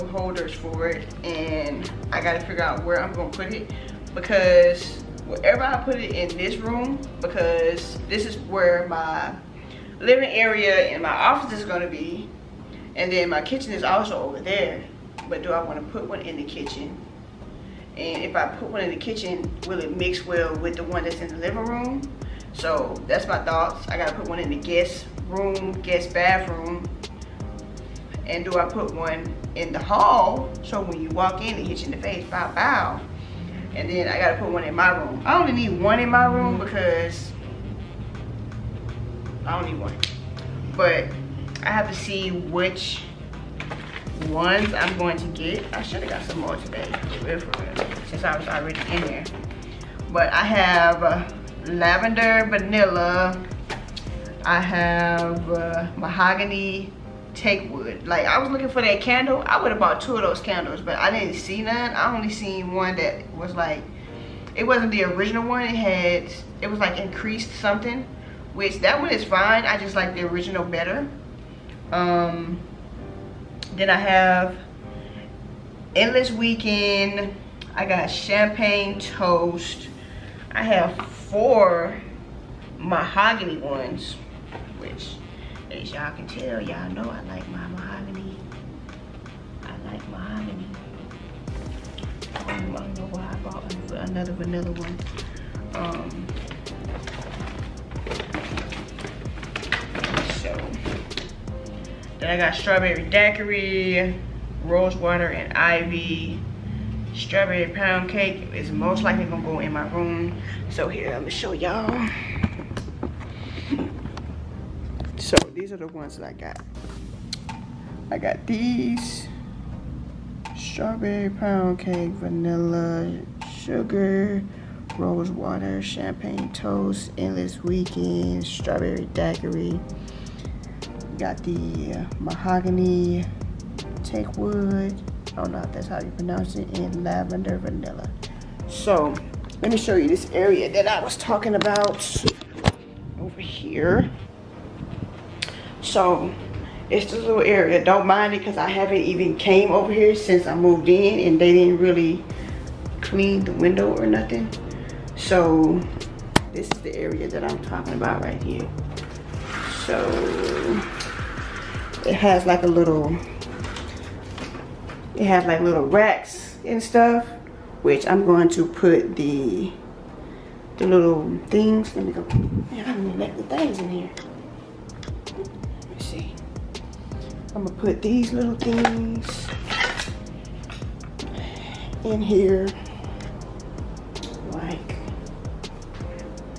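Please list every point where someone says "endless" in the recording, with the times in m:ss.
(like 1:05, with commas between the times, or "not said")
1:15, 2:07.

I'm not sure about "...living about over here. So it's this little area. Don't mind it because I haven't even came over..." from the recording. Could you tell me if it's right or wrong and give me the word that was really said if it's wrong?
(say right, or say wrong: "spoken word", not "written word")
wrong: "talking", not "living".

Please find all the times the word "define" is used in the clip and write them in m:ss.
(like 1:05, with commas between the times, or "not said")
not said.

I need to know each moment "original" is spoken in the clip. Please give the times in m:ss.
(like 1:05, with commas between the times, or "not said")
1:05, 1:10.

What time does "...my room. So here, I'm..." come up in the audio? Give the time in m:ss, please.
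1:49.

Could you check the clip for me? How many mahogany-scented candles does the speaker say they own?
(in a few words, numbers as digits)
4.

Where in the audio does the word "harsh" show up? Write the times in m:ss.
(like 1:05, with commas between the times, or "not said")
not said.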